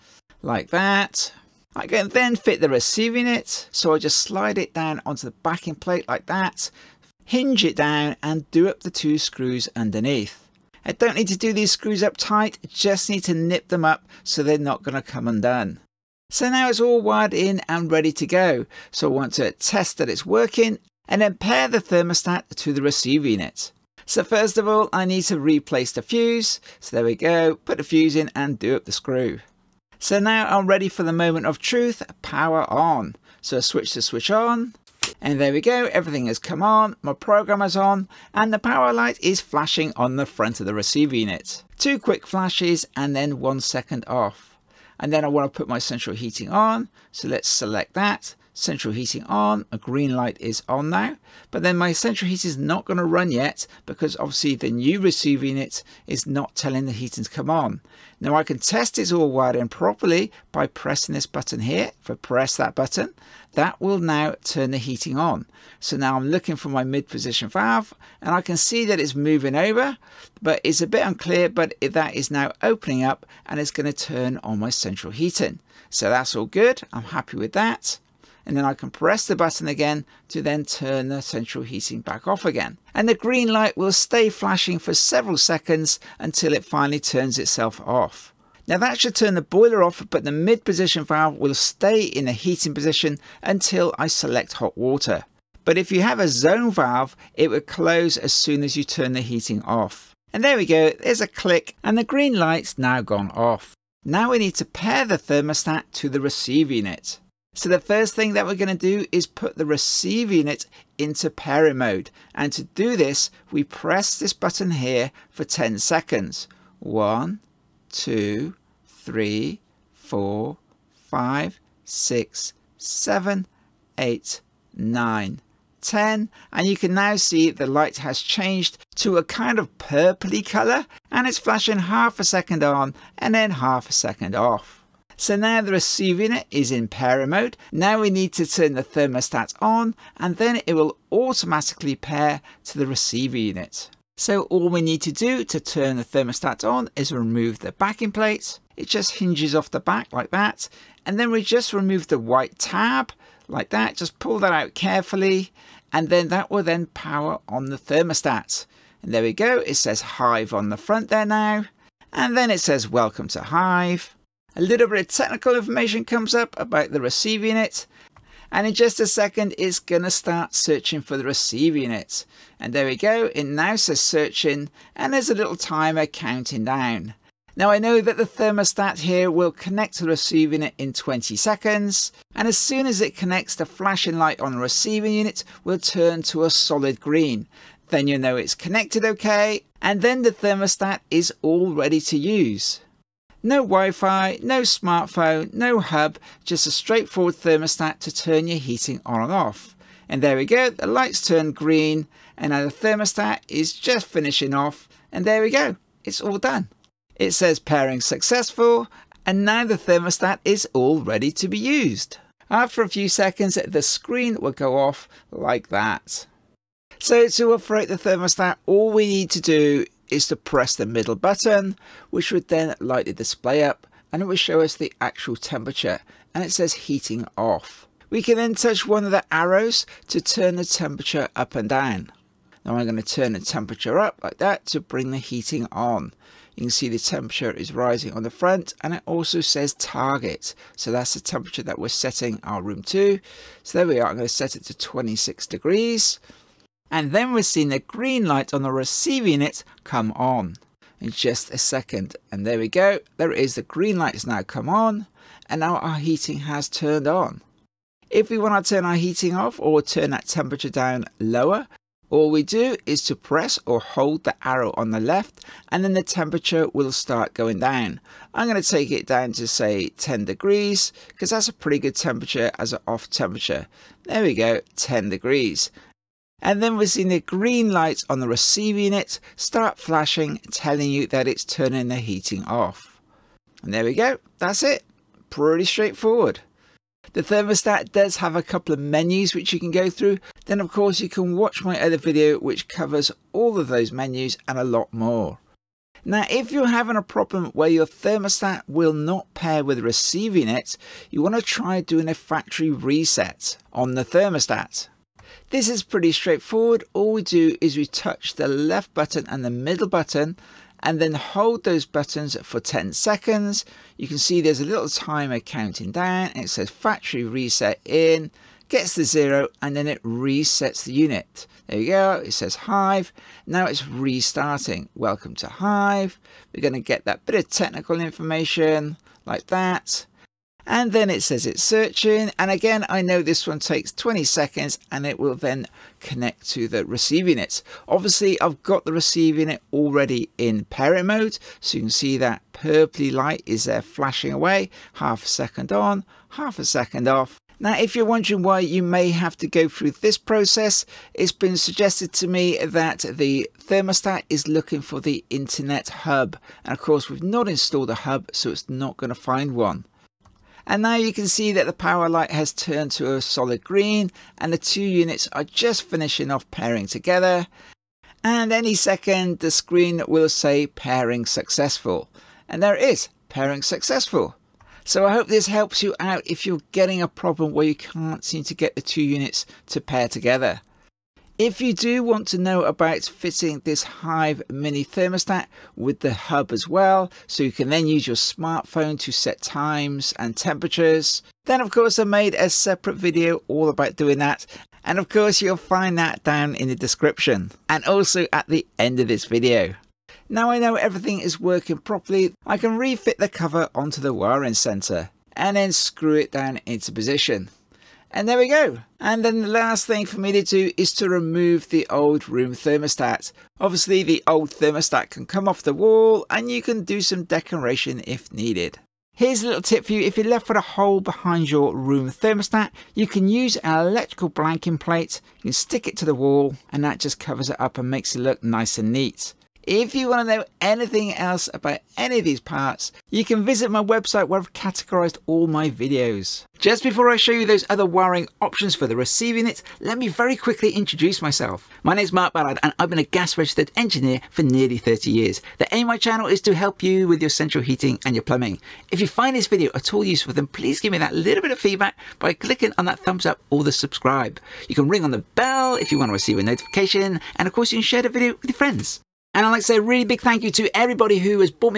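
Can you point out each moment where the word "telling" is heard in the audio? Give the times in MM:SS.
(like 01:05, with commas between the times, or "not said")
00:56, 04:40.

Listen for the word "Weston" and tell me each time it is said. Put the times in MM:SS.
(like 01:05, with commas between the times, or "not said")
not said.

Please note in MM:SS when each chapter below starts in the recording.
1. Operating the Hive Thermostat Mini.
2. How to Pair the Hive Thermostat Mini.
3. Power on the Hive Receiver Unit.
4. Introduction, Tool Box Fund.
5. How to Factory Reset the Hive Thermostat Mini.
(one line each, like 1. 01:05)
1. 03:35
2. 01:46
3. 00:28
4. 07:17
5. 04:54.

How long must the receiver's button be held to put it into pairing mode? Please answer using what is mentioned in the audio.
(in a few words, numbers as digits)
10 seconds.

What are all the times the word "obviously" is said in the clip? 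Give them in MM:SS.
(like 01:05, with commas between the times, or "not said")
00:54, 05:37, 06:53.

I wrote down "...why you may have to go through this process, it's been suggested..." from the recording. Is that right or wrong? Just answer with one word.
right.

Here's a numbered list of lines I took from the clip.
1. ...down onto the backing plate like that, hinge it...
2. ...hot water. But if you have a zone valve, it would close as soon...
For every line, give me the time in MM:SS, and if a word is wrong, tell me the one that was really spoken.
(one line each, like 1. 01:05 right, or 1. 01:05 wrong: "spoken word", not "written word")
1. 00:04 right
2. 01:34 right.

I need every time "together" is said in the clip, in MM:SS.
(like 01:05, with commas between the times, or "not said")
06:06, 06:20.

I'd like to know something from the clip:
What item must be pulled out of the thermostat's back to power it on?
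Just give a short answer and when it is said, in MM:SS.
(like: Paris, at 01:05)
White tab, at 02:32.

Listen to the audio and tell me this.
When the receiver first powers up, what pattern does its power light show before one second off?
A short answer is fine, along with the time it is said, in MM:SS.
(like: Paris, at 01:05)
Two quick flashes, at 00:41.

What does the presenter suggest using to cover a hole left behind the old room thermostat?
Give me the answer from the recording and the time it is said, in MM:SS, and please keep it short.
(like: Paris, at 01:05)
Electrical blanking plate, at 07:03.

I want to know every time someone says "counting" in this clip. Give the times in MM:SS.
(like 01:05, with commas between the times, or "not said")
02:56, 05:15.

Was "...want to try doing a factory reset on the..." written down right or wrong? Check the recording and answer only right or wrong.
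right.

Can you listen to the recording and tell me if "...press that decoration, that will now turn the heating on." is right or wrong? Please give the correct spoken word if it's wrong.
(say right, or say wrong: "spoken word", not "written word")
wrong: "button", not "decoration".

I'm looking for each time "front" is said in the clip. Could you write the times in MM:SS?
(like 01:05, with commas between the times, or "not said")
00:40, 02:40, 03:58.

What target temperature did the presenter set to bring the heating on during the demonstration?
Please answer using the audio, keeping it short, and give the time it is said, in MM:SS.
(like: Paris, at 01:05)
26 degrees, at 04:04.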